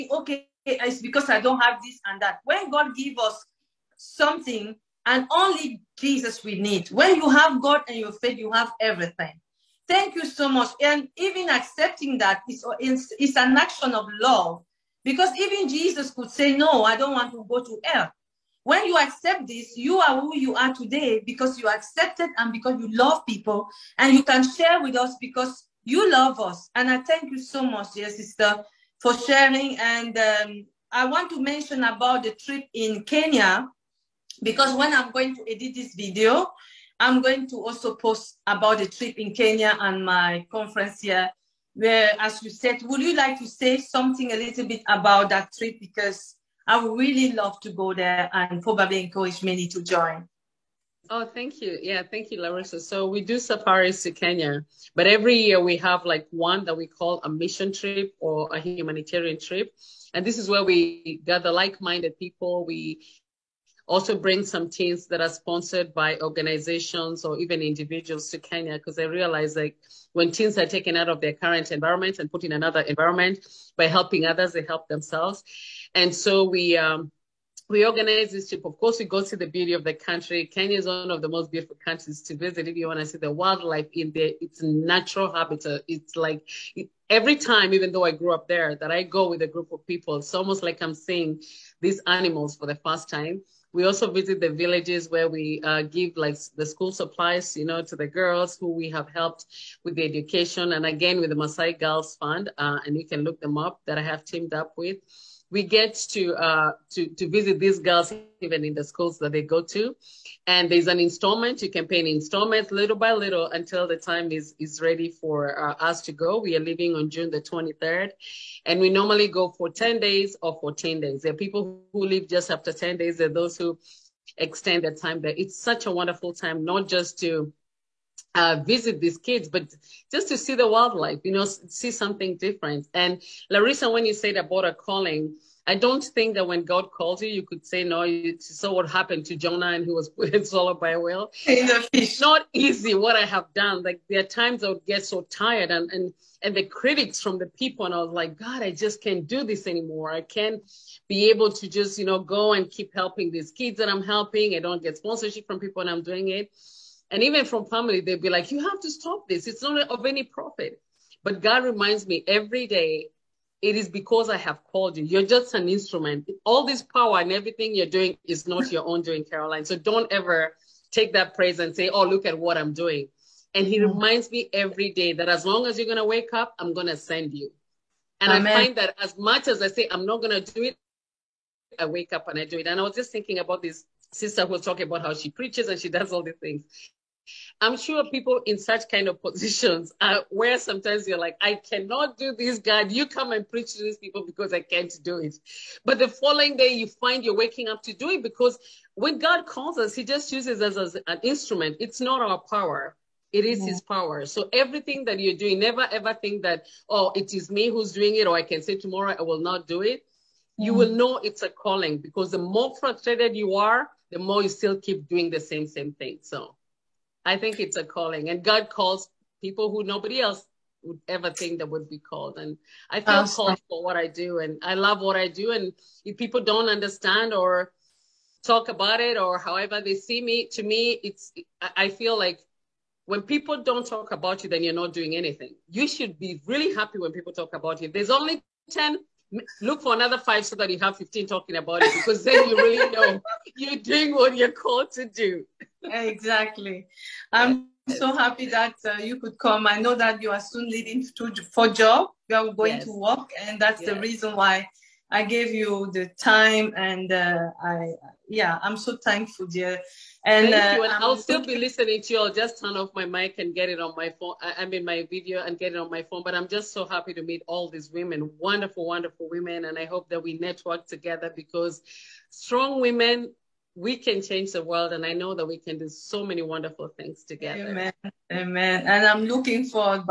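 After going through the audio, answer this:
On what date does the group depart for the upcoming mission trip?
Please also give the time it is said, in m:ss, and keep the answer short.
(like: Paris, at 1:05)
June 23, at 1:57.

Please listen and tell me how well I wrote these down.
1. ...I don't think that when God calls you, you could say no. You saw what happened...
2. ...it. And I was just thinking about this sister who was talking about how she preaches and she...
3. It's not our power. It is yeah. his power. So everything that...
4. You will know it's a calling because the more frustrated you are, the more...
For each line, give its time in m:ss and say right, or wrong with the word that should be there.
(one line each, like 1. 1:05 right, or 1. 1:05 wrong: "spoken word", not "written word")
1. 2:15 right
2. 3:02 right
3. 3:21 right
4. 3:30 right.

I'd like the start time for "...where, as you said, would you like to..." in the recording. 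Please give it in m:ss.
0:41.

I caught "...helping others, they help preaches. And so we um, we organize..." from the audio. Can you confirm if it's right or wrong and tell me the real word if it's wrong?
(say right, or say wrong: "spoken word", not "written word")
wrong: "themselves", not "preaches".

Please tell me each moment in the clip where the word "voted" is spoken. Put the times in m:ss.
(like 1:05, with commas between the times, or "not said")
not said.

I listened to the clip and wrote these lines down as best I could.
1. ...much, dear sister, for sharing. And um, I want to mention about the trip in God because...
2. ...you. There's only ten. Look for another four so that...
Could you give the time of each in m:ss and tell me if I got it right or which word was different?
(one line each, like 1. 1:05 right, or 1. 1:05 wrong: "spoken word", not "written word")
1. 0:27 wrong: "Kenya", not "God"
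2. 3:57 wrong: "five", not "four".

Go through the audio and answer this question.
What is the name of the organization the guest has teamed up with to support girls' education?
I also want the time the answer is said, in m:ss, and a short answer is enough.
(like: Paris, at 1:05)
Maasai Girls Fund, at 1:41.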